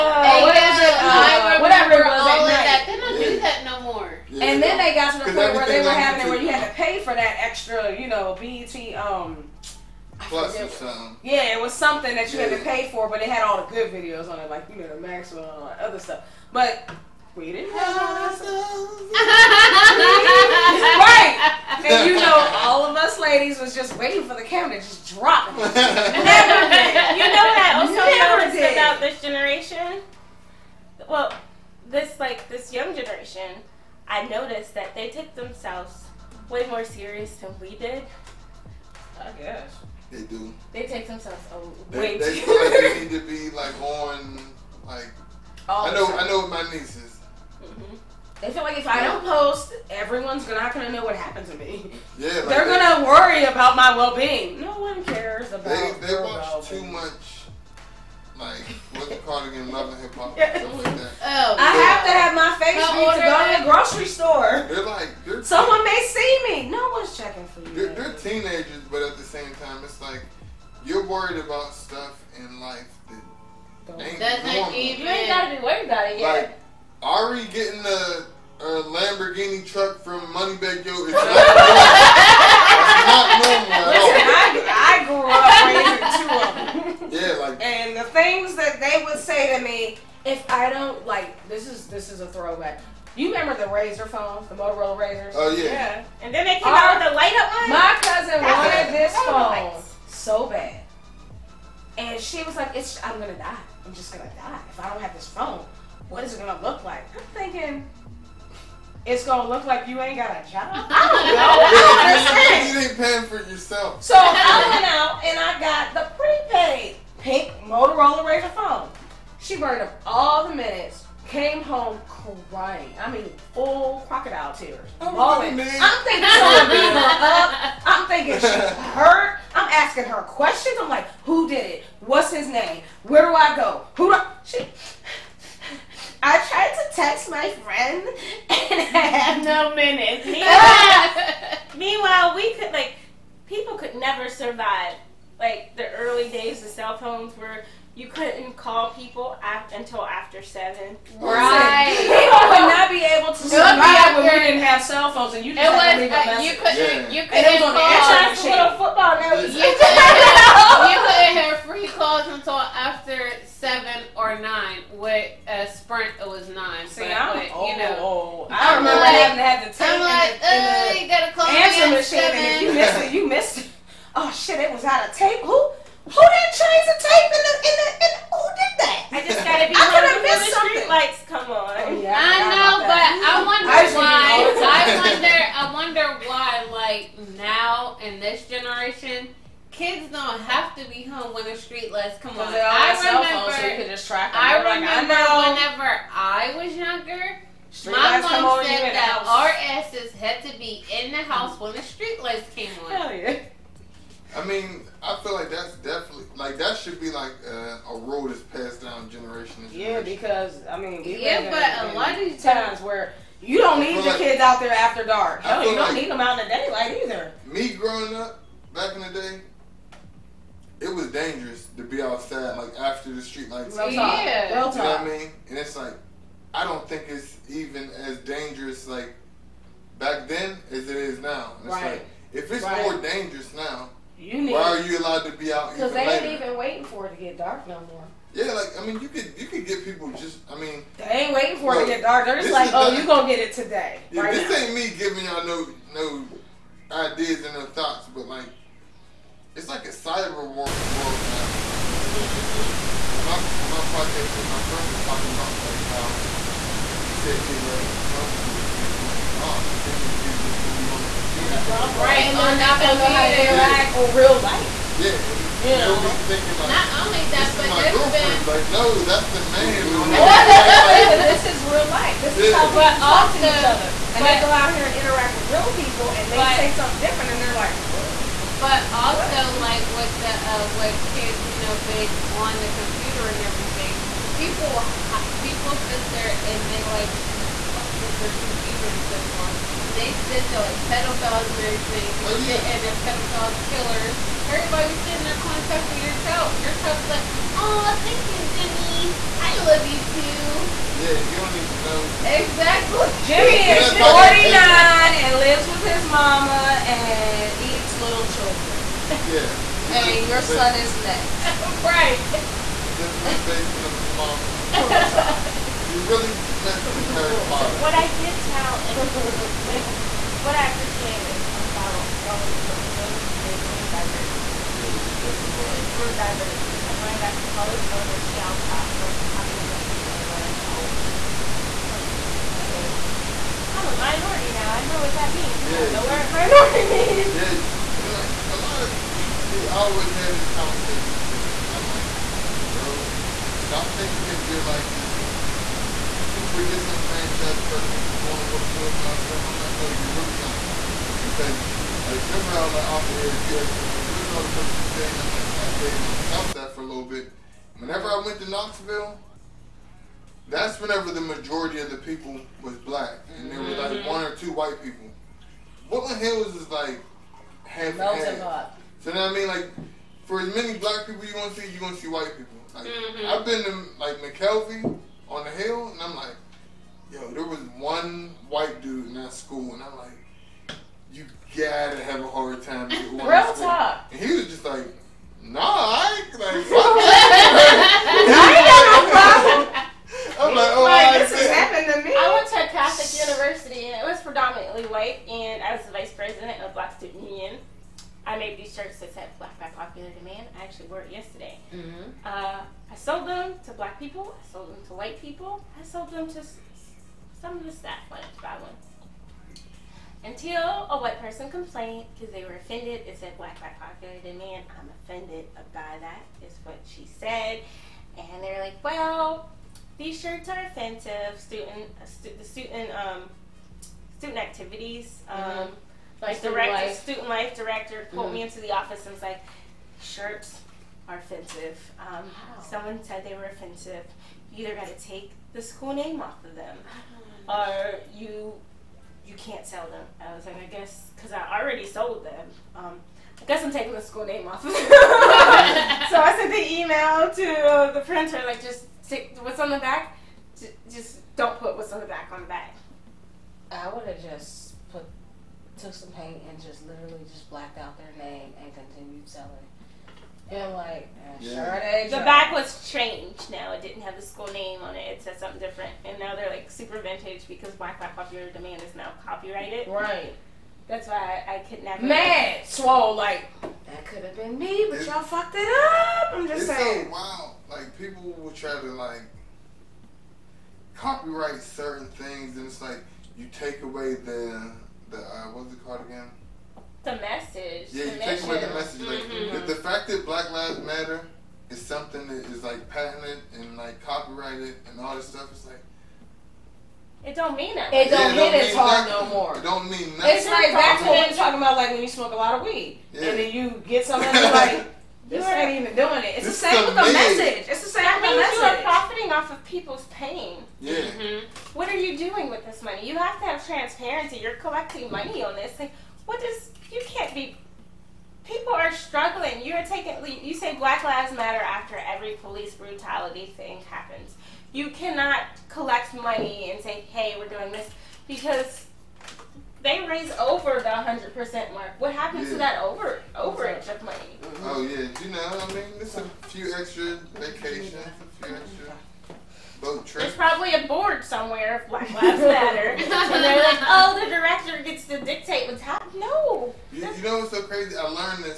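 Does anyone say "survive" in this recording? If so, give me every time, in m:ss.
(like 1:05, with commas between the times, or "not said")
2:24, 2:33.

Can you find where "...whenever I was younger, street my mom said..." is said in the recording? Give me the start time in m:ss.
3:15.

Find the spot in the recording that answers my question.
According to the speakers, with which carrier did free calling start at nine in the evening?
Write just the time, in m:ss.
2:45.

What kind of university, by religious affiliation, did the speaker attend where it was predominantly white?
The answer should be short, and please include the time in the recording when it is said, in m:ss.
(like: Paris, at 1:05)
Catholic, at 6:32.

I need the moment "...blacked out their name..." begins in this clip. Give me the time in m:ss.
7:37.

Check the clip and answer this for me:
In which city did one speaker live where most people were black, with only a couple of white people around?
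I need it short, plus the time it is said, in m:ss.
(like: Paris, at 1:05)
Knoxville, at 5:58.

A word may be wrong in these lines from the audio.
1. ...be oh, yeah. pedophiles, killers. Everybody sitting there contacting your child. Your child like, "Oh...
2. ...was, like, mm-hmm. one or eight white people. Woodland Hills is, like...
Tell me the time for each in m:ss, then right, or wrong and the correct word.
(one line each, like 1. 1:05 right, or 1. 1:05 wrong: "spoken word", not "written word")
1. 4:52 right
2. 6:03 wrong: "two", not "eight".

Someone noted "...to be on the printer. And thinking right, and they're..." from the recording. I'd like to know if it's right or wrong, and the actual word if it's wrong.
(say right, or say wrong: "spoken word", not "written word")
wrong: "computer", not "printer".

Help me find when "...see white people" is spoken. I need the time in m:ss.
6:11.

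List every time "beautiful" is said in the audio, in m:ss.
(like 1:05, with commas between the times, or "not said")
not said.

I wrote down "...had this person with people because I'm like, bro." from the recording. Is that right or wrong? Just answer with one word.
wrong.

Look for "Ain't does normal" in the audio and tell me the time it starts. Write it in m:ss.
1:13.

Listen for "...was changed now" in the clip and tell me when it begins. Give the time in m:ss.
7:42.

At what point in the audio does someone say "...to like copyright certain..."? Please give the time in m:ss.
7:58.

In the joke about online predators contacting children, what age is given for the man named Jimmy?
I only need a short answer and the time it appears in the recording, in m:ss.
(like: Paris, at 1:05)
49, at 5:03.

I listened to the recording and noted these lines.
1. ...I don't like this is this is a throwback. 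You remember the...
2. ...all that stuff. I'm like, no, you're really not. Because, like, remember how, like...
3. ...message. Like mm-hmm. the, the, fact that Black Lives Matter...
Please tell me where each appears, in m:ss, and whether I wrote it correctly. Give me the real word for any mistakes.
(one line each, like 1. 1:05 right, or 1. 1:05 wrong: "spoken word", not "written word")
1. 1:30 right
2. 5:49 right
3. 8:08 right.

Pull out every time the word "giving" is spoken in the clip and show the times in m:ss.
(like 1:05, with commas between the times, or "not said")
4:04.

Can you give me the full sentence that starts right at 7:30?
Just don't put what's on the back on the back.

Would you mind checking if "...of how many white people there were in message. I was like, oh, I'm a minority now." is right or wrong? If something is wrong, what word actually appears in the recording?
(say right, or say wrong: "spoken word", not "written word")
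wrong: "college", not "message".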